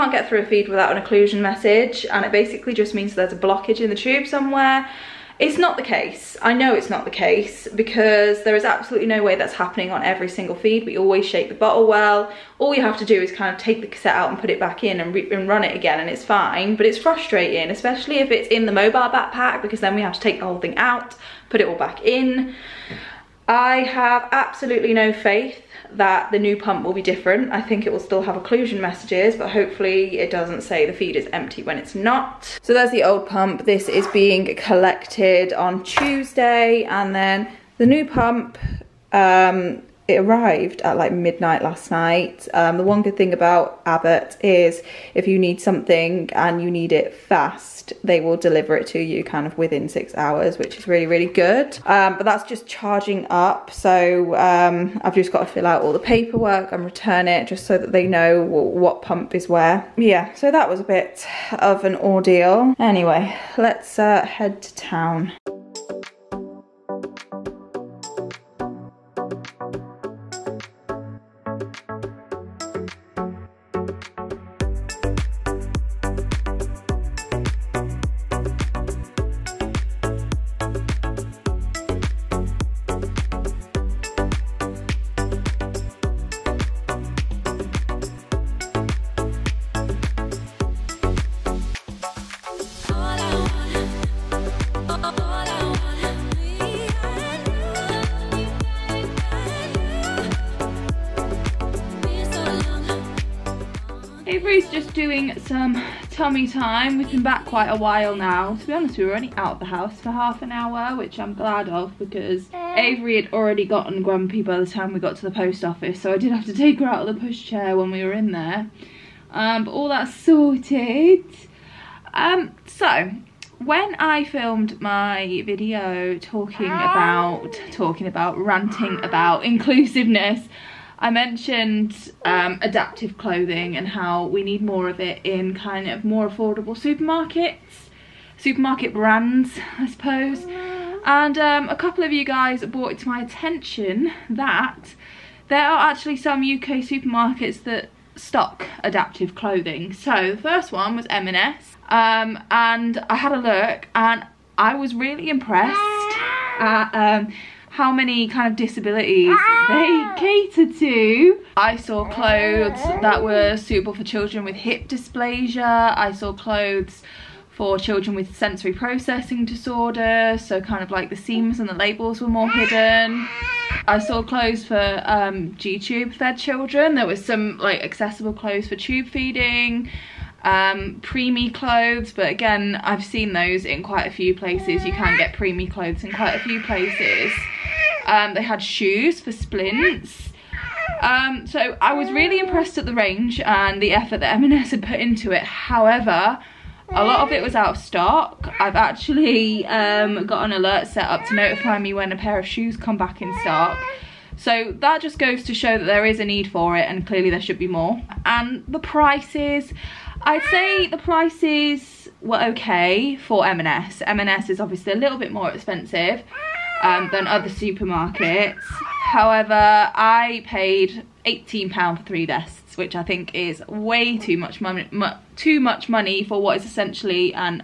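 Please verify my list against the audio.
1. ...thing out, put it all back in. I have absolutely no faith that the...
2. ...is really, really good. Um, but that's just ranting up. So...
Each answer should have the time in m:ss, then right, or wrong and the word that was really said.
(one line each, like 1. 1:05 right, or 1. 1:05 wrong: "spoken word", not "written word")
1. 0:20 right
2. 0:50 wrong: "charging", not "ranting".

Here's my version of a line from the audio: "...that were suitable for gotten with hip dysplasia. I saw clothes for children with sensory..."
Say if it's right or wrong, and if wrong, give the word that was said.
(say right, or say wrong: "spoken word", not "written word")
wrong: "children", not "gotten".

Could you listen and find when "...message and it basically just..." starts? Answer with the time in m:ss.
0:01.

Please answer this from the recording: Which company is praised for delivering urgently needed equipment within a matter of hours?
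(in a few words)
Abbott.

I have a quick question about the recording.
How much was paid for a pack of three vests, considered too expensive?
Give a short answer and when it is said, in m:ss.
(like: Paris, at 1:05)
£18, at 3:41.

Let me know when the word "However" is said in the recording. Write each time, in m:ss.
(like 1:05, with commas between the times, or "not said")
3:15, 3:38.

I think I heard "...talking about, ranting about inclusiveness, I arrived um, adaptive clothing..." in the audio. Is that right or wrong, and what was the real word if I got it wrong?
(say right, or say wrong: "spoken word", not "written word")
wrong: "mentioned", not "arrived".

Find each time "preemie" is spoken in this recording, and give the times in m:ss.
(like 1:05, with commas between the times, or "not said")
3:01, 3:05.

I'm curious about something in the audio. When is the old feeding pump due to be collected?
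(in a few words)
Tuesday.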